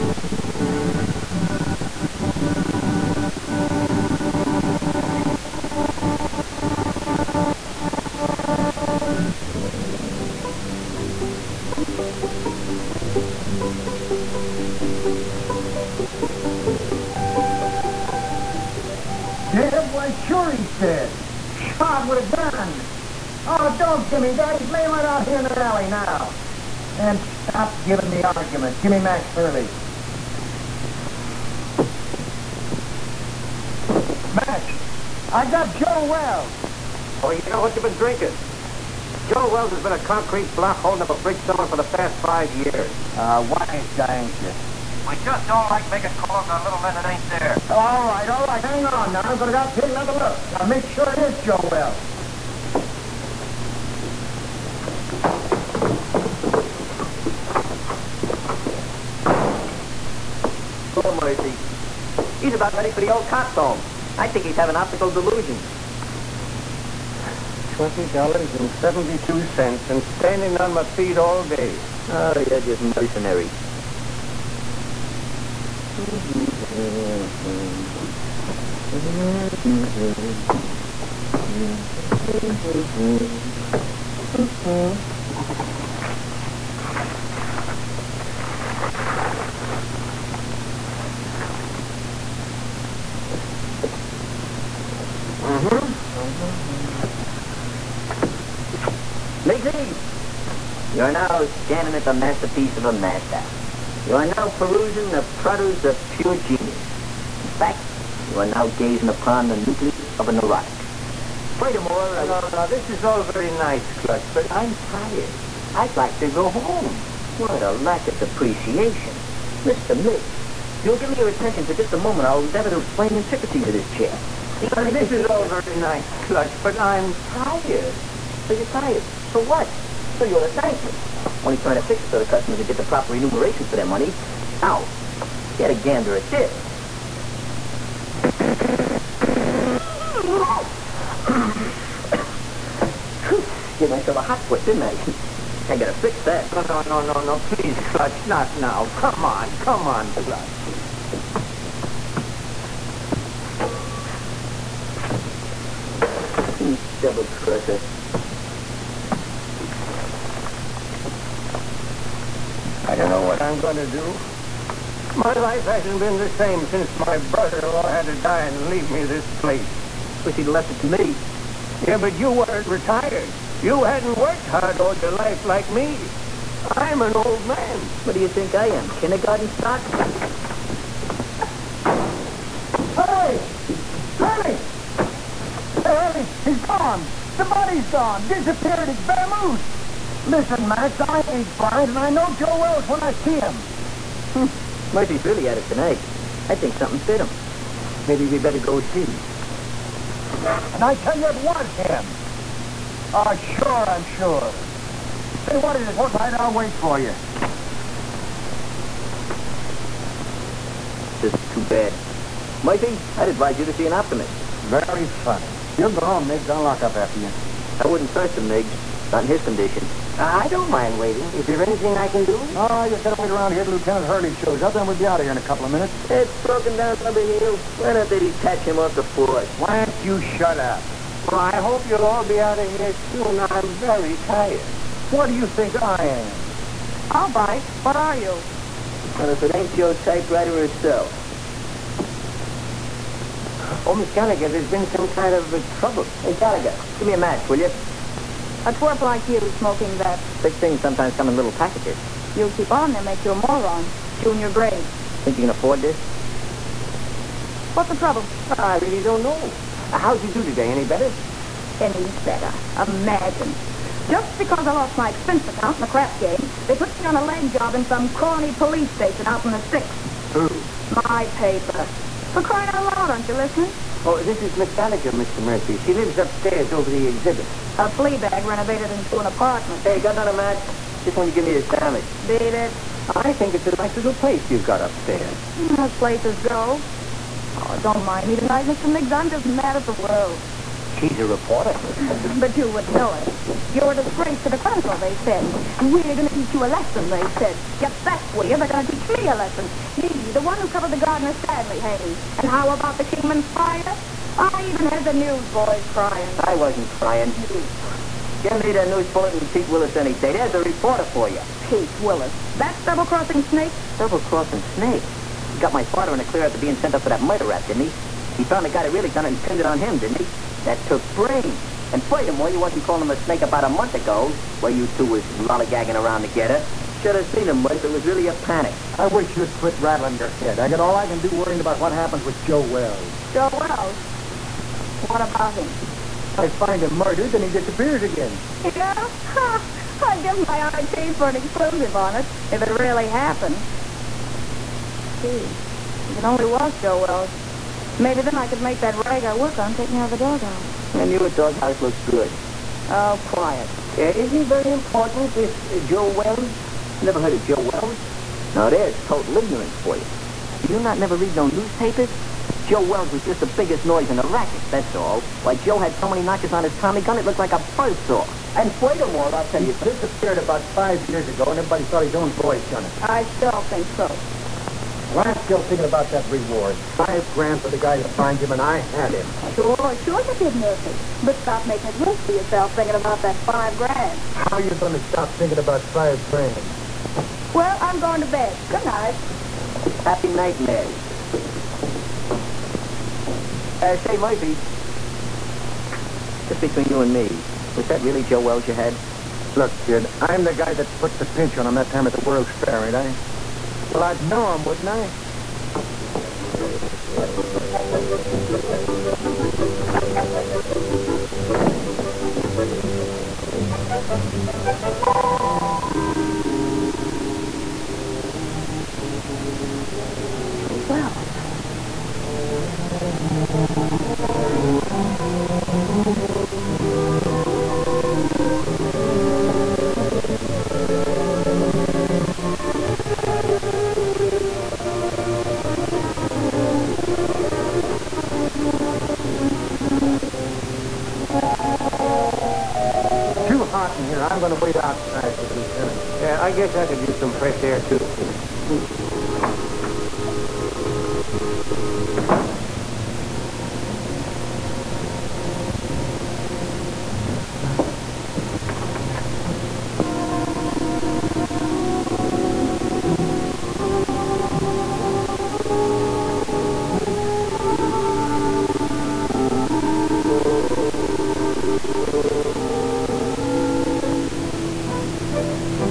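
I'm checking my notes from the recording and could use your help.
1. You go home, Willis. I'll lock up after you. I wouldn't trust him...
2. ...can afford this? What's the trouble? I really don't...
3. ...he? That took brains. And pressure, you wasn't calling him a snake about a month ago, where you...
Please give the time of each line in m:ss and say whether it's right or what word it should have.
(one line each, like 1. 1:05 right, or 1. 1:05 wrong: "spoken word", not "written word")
1. 3:35 wrong: "Miggs", not "Willis"
2. 4:15 right
3. 5:20 wrong: "furthermore", not "pressure".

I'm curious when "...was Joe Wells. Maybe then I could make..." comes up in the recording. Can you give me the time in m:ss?
5:46.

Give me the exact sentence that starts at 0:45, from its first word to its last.
We just don't like making calls on little men that ain't there.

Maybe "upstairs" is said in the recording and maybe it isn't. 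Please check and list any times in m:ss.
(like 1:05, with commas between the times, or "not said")
4:36, 4:44.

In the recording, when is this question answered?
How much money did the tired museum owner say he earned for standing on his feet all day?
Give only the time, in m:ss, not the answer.
1:07.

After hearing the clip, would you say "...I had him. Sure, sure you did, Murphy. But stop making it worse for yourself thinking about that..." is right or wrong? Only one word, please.
right.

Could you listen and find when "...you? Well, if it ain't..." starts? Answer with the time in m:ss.
3:58.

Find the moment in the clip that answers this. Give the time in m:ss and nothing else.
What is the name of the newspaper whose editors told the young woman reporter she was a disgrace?
4:54.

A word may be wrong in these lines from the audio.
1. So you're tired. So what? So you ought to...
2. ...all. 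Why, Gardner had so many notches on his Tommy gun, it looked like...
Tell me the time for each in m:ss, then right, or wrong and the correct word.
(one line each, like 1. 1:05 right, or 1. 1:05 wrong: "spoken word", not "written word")
1. 2:08 right
2. 6:04 wrong: "Joe", not "Gardner".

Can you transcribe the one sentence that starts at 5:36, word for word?
I find him murdered, then he disappears again.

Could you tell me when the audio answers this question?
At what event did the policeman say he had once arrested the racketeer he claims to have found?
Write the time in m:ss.
6:42.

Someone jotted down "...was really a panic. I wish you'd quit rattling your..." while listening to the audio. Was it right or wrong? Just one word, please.
right.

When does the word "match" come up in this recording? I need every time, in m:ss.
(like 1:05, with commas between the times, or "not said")
4:07, 4:40.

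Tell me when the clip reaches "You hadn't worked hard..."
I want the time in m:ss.
2:53.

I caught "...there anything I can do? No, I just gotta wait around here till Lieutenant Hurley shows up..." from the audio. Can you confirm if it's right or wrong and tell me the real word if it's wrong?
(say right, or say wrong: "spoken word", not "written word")
right.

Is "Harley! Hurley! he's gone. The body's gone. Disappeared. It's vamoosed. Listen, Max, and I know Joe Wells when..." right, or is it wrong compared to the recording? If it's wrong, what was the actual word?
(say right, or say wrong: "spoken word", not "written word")
right.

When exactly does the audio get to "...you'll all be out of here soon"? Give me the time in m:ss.
3:51.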